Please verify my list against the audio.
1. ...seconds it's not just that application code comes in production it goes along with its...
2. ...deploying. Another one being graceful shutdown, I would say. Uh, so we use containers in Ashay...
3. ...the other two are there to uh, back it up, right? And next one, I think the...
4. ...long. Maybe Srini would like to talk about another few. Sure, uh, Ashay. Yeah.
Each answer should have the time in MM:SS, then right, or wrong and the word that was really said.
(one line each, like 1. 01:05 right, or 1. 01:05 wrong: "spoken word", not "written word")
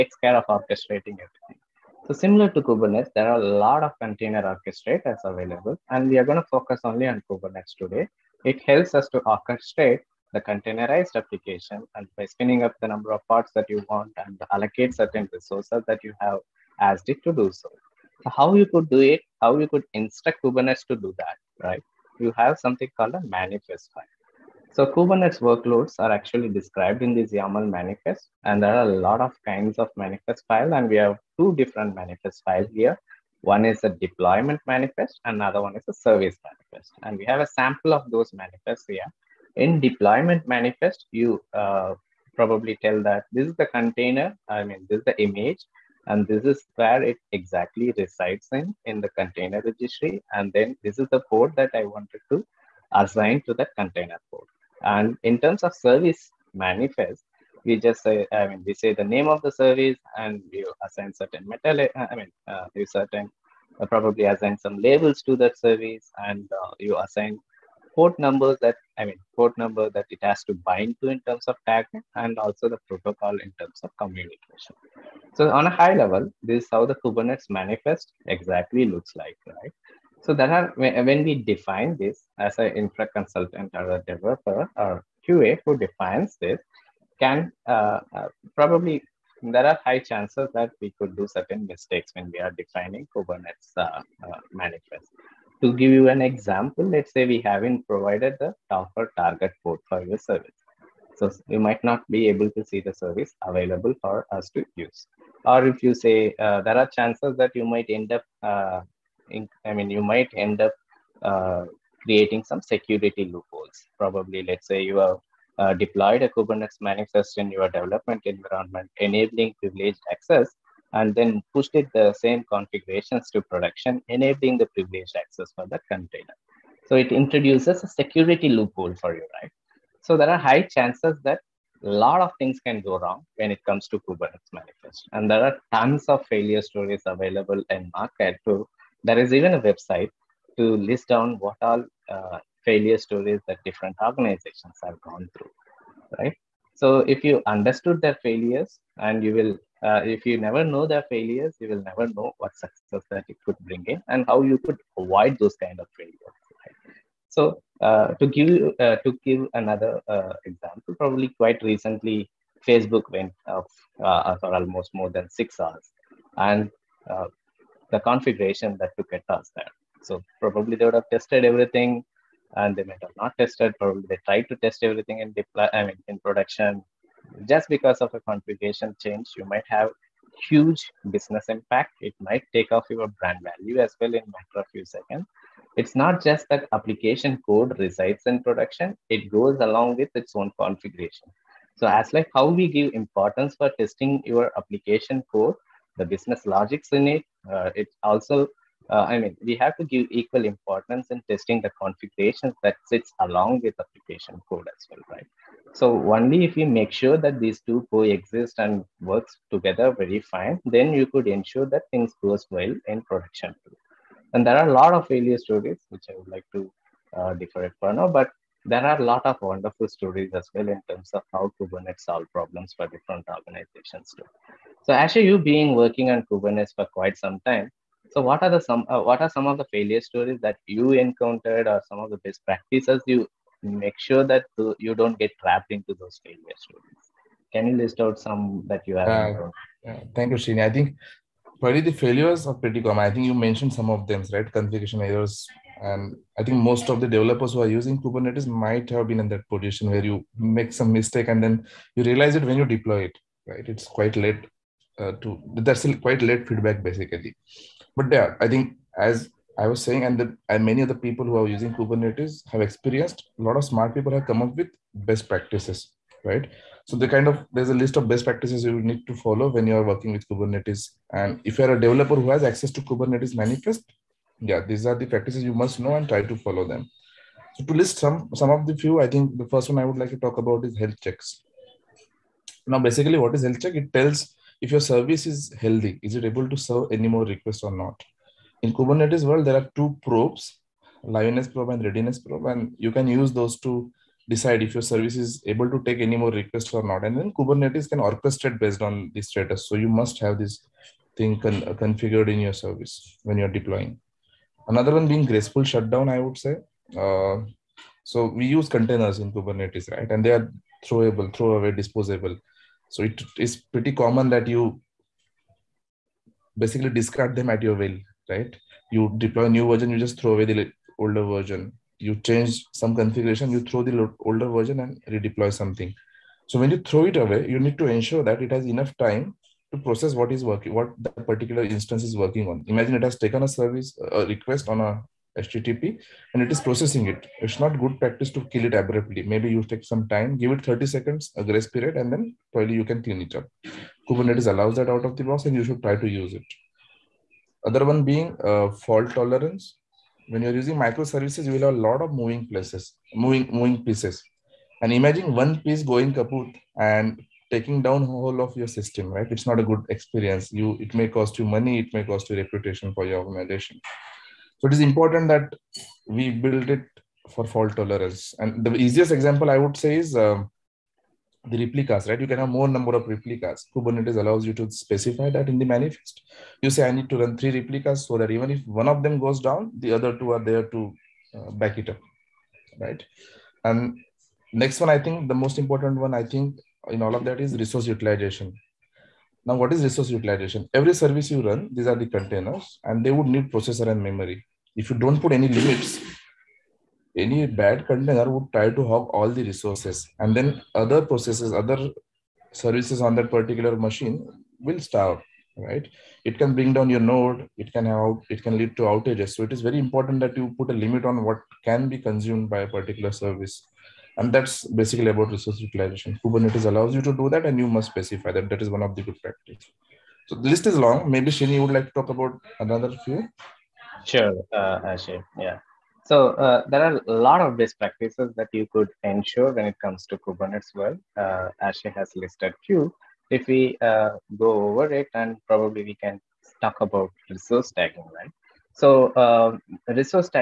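1. 03:04 wrong: "resides", not "comes"
2. 05:03 wrong: "Kubernetes", not "Ashay"
3. 06:19 right
4. 07:00 right.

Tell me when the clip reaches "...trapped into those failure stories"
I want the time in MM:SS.
03:55.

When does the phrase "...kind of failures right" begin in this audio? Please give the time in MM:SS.
02:35.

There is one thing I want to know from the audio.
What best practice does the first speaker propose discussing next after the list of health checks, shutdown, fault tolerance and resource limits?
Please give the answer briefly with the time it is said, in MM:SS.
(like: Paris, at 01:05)
resource tagging, at 07:17.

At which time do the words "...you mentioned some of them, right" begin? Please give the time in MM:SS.
04:03.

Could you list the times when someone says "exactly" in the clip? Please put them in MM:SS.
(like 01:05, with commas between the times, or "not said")
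00:47, 01:18.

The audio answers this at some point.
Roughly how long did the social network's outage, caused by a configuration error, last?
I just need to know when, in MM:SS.
02:44.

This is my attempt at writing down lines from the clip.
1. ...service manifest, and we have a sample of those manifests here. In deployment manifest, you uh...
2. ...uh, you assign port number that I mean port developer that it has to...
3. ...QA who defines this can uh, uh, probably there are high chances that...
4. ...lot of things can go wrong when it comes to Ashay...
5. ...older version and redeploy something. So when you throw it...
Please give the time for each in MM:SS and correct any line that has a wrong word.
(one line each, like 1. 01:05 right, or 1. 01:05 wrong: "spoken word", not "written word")
1. 00:35 right
2. 01:06 wrong: "number", not "developer"
3. 01:25 right
4. 02:11 wrong: "Kubernetes", not "Ashay"
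5. 05:24 right.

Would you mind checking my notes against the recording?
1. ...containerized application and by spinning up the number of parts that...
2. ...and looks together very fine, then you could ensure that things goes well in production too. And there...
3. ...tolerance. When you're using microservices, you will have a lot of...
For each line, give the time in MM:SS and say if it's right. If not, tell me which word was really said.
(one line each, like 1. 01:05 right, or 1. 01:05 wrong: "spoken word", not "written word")
1. 00:10 right
2. 03:28 wrong: "works", not "looks"
3. 05:49 right.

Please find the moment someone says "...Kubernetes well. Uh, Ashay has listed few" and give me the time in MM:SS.
07:10.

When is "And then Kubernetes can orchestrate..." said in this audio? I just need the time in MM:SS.
04:57.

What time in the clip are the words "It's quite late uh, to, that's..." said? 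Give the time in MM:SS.
04:13.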